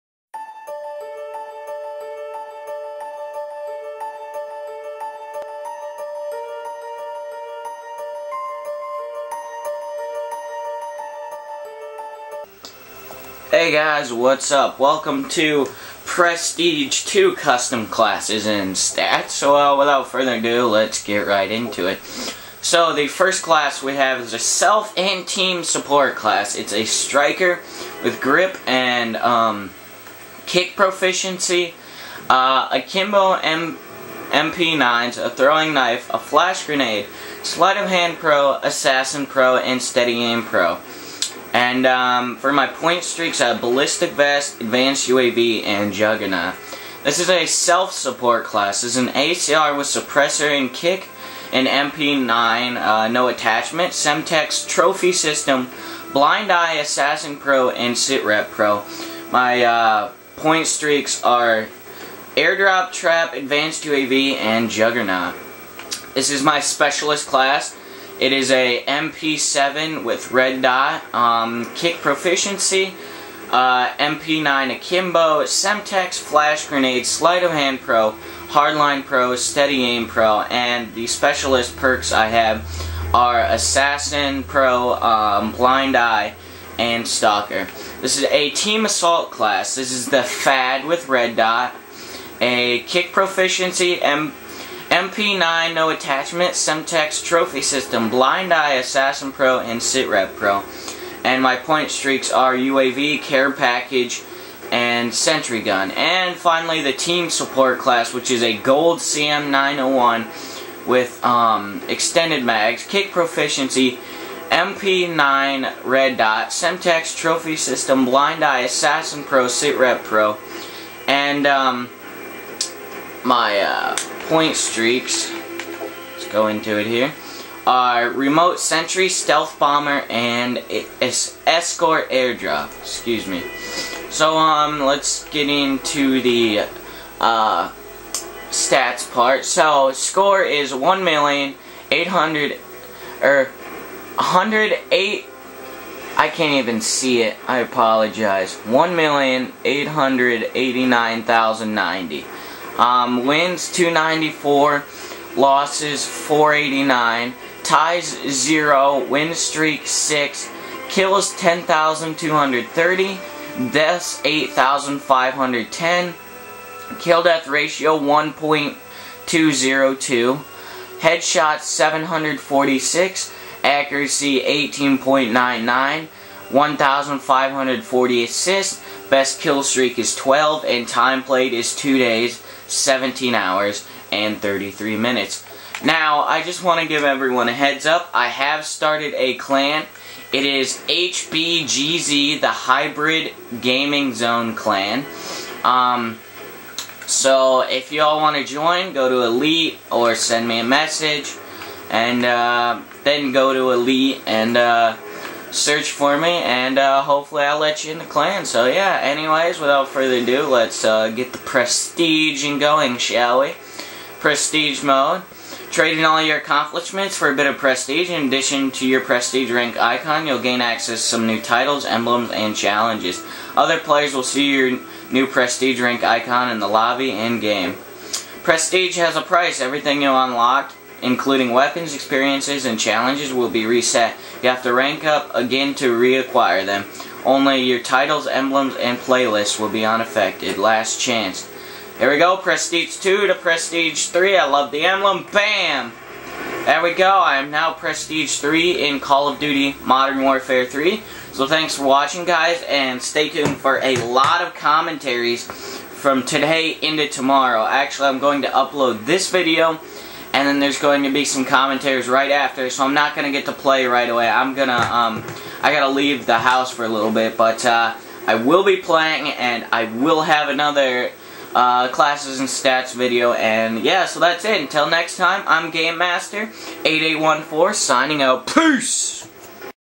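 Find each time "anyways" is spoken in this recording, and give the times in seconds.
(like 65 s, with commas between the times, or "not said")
209 s.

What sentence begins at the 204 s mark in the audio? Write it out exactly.
Uh, search for me, and uh, hopefully I'll let you in the clan.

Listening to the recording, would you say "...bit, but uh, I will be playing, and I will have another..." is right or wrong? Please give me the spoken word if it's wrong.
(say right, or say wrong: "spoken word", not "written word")
right.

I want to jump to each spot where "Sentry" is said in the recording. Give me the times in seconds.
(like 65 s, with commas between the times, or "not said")
105 s, 128 s.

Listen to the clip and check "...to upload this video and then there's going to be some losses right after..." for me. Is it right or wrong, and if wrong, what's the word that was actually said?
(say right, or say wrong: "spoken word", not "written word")
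wrong: "commentaries", not "losses".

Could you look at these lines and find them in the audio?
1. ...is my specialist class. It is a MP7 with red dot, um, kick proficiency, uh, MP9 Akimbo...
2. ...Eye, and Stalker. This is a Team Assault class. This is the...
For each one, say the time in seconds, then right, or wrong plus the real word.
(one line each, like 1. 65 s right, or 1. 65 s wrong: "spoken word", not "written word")
1. 66 s right
2. 85 s right.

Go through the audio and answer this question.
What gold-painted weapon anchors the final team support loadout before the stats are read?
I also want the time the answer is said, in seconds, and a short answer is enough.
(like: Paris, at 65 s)
CM901, at 108 s.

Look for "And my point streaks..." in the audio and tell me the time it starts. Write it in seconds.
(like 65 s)
101 s.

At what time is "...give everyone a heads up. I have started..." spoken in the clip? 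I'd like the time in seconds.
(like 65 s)
186 s.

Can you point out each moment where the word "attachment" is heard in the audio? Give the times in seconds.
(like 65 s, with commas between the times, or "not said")
53 s, 95 s.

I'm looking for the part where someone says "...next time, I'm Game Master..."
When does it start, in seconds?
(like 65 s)
274 s.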